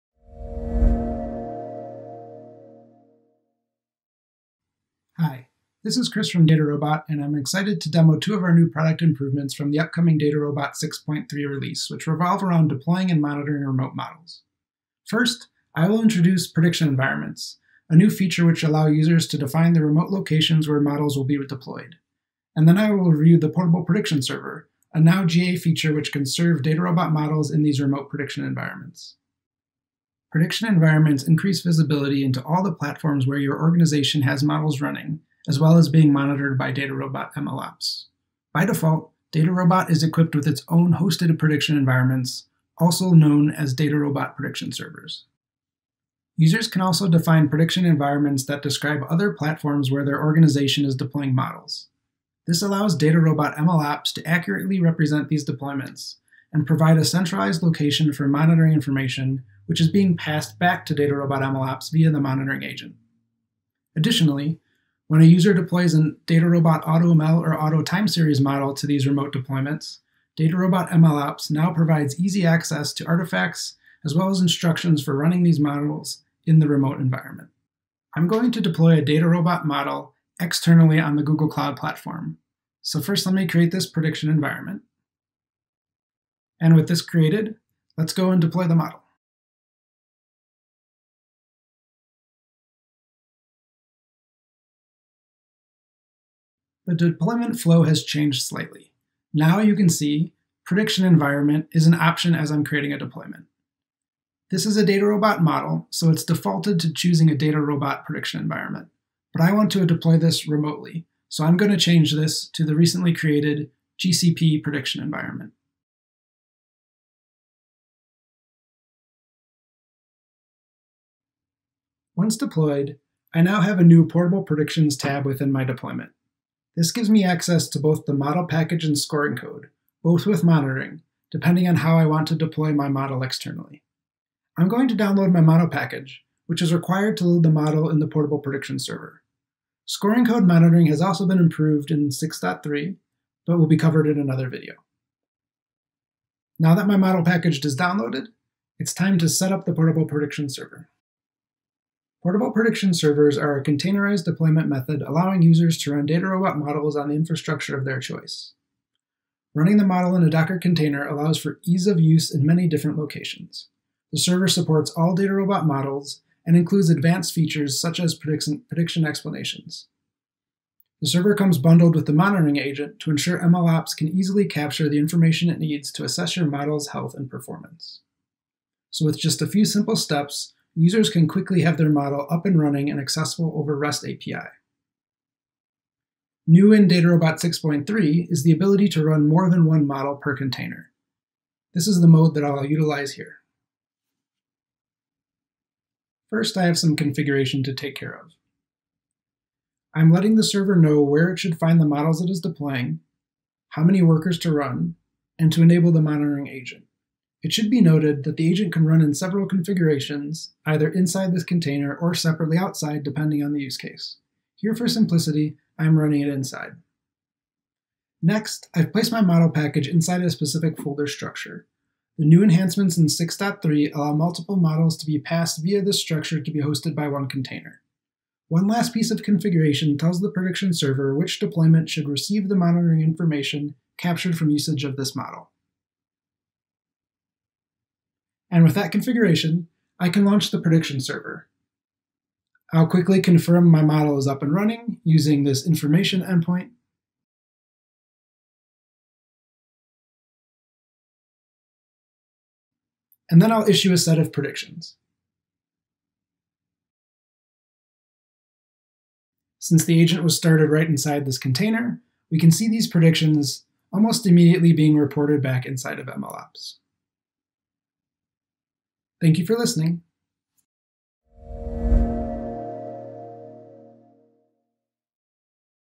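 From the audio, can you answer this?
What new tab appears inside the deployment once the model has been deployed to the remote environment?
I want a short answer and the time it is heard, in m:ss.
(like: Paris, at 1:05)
Portable Predictions, at 2:04.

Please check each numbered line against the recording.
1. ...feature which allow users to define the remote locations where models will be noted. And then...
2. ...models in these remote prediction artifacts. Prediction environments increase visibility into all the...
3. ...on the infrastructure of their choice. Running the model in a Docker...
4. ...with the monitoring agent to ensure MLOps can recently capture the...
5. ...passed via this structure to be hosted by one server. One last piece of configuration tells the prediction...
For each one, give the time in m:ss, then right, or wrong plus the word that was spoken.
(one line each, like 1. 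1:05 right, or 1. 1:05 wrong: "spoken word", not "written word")
1. 0:18 wrong: "deployed", not "noted"
2. 0:27 wrong: "environments", not "artifacts"
3. 2:36 right
4. 2:51 wrong: "easily", not "recently"
5. 3:45 wrong: "container", not "server".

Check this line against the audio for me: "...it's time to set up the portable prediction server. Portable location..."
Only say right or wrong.
wrong.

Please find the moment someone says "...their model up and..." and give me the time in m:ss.
3:01.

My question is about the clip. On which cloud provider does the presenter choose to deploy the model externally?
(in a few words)
Google Cloud Platform.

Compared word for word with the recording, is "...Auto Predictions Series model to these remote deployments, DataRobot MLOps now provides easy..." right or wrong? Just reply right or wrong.
wrong.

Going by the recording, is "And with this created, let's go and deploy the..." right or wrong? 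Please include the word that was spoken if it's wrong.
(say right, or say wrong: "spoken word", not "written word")
right.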